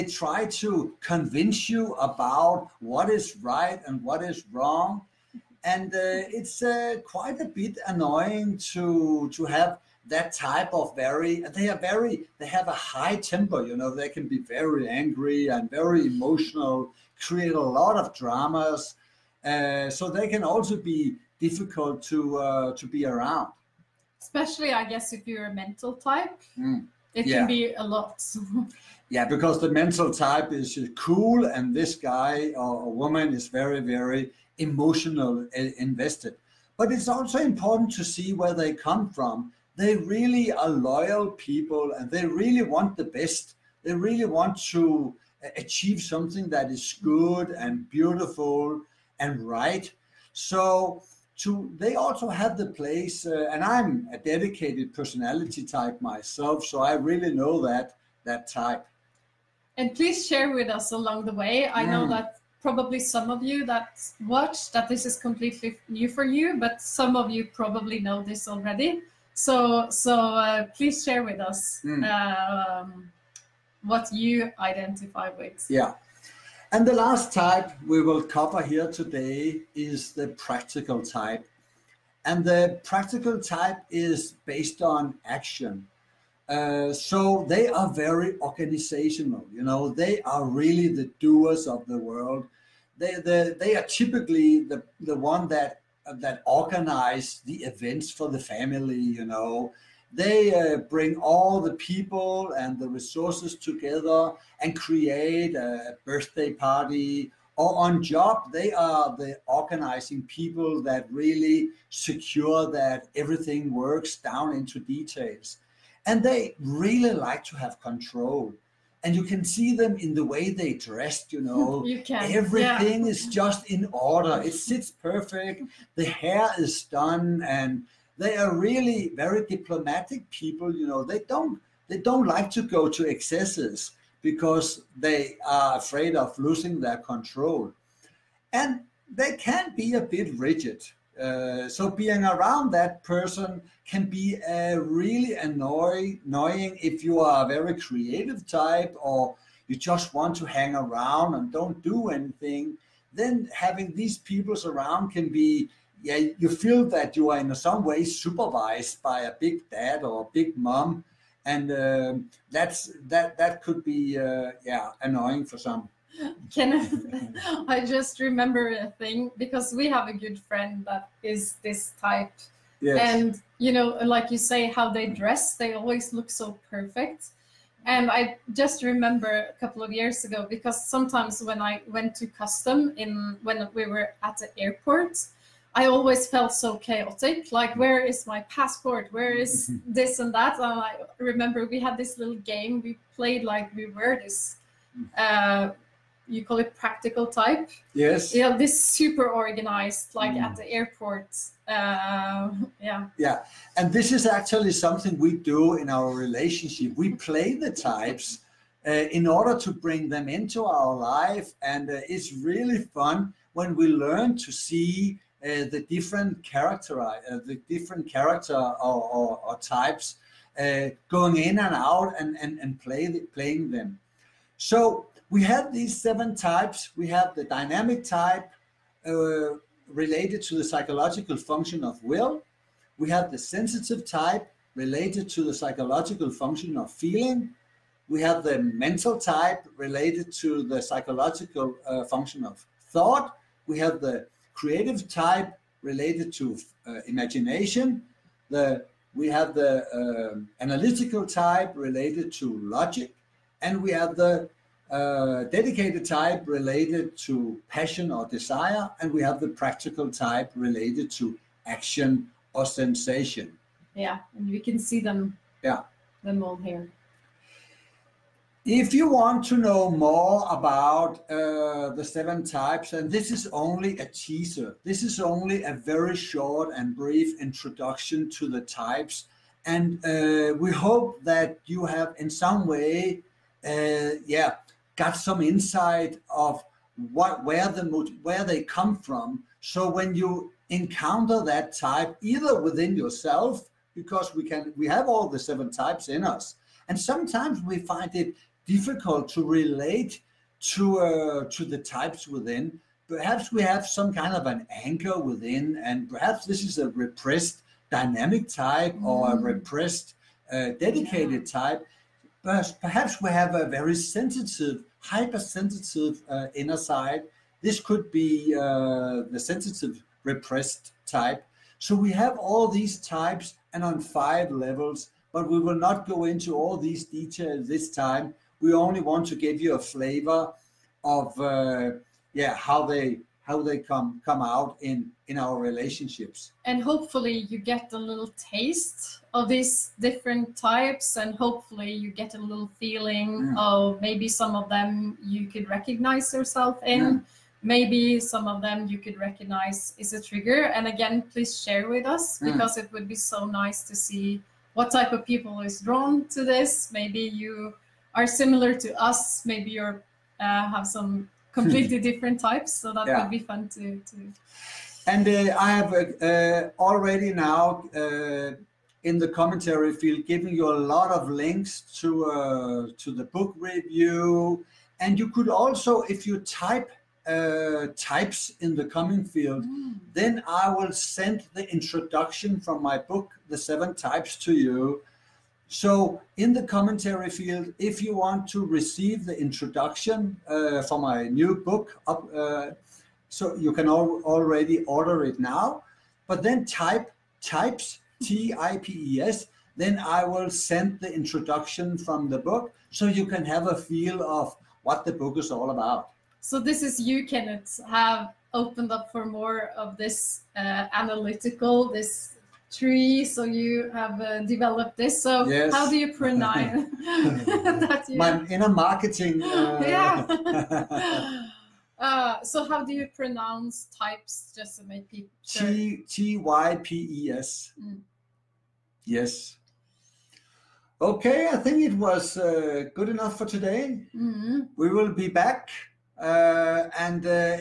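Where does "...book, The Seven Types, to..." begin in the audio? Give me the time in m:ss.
6:22.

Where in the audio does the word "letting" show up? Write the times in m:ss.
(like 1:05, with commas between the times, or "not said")
not said.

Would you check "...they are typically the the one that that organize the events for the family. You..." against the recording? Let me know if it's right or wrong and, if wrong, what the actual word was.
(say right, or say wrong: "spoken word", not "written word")
right.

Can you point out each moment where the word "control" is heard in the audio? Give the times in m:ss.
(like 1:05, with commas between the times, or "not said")
1:57, 2:16.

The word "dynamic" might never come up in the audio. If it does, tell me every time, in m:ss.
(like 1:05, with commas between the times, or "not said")
3:47, 5:07.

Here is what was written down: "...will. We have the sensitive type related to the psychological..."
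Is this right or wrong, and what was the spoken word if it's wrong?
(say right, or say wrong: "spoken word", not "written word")
right.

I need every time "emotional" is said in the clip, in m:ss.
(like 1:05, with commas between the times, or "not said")
0:16, 0:34.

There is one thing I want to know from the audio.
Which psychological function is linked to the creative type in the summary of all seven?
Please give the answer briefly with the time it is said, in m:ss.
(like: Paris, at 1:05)
Imagination, at 4:07.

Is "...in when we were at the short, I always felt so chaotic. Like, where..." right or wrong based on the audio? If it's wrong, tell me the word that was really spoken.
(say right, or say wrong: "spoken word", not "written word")
wrong: "airport", not "short".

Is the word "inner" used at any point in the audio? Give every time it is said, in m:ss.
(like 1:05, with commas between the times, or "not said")
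5:16, 6:58.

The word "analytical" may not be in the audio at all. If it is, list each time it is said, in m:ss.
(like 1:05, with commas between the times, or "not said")
4:10, 6:50.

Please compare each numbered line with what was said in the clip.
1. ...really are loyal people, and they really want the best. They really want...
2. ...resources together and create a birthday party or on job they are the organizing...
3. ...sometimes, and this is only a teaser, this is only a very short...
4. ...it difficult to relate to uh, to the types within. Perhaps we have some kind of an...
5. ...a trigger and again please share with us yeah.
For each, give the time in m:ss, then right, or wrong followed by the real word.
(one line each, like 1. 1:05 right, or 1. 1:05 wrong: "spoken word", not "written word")
1. 0:39 right
2. 1:42 right
3. 4:32 wrong: "types", not "sometimes"
4. 4:58 right
5. 5:50 right.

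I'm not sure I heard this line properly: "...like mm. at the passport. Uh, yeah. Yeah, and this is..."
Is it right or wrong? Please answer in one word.
wrong.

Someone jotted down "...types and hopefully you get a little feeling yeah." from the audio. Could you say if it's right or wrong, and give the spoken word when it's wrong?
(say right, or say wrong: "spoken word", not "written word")
right.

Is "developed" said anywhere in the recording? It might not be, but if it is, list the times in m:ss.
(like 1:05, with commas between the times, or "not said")
6:54.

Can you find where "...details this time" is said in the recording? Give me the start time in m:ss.
5:27.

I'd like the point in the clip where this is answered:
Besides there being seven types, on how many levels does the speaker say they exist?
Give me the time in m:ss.
5:23.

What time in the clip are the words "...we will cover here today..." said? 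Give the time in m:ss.
1:17.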